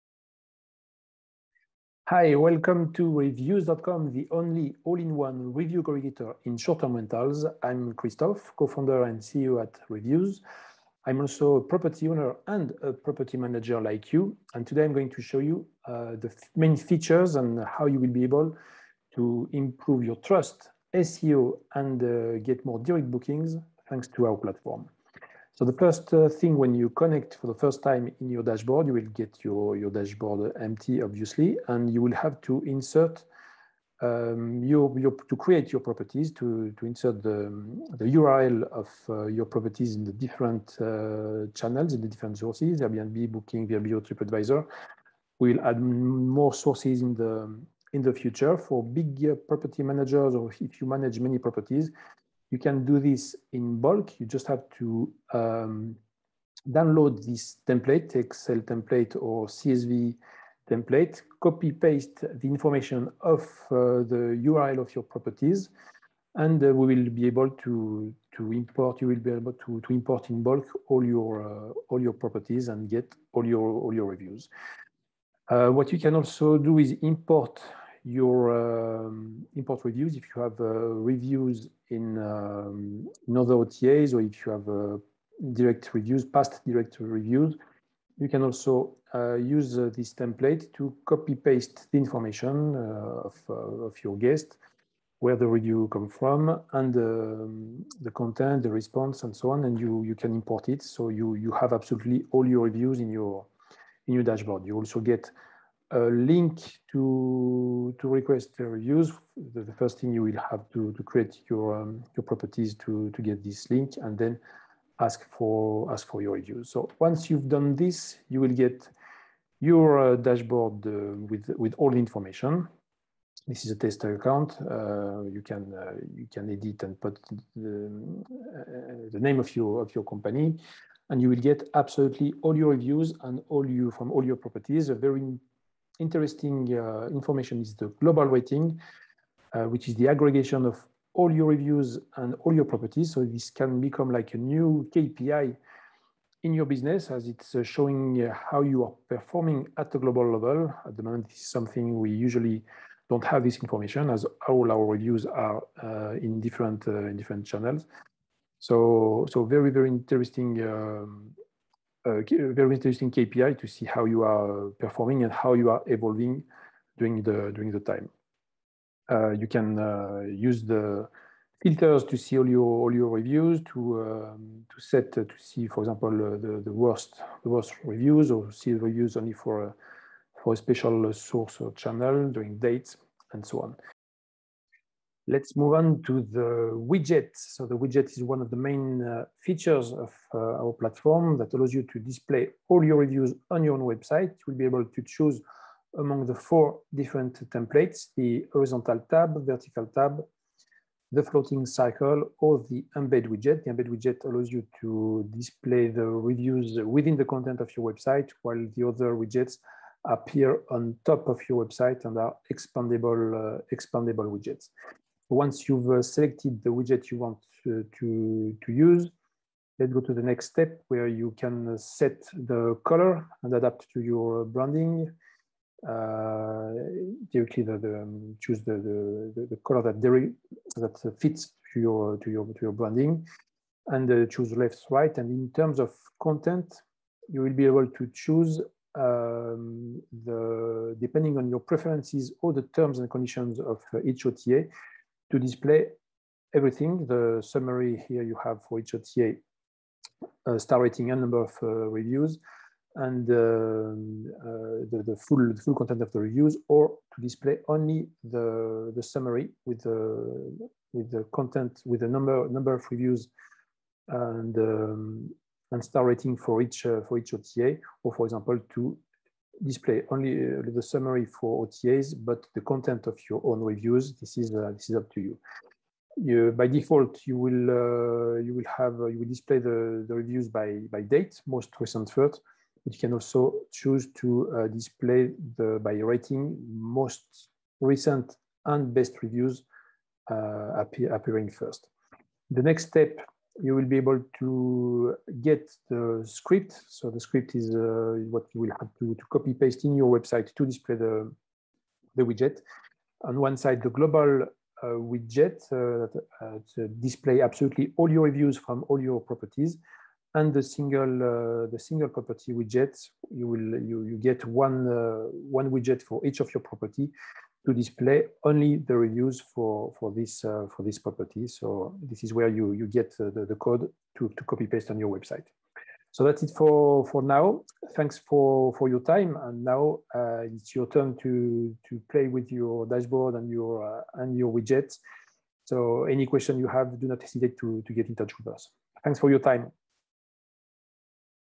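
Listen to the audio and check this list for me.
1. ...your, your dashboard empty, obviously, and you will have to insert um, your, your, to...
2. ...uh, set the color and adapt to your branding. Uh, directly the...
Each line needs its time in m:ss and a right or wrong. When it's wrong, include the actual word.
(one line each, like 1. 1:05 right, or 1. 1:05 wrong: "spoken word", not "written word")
1. 0:29 right
2. 3:41 right.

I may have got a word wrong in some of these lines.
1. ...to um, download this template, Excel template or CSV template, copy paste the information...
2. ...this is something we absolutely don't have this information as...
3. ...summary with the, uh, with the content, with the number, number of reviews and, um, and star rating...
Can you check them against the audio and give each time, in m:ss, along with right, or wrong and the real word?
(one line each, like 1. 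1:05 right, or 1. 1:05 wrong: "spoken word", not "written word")
1. 0:54 right
2. 2:31 wrong: "usually", not "absolutely"
3. 4:19 right.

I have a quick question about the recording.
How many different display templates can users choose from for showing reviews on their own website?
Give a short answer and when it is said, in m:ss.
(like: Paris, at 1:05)
4, at 3:16.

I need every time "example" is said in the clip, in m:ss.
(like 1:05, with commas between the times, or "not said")
2:55, 4:28.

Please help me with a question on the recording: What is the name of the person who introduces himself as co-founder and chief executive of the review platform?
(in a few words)
Christophe.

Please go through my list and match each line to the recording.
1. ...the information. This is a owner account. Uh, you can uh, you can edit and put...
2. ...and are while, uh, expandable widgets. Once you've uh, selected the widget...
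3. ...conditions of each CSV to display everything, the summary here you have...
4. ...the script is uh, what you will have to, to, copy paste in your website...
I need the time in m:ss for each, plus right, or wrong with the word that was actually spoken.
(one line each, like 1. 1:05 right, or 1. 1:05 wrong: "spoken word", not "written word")
1. 2:01 wrong: "tester", not "owner"
2. 3:32 wrong: "expandable", not "while"
3. 4:03 wrong: "OTA", not "CSV"
4. 4:57 right.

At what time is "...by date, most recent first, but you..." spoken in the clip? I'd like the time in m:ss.
4:40.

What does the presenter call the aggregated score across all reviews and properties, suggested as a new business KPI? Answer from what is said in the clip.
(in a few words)
Global weighting.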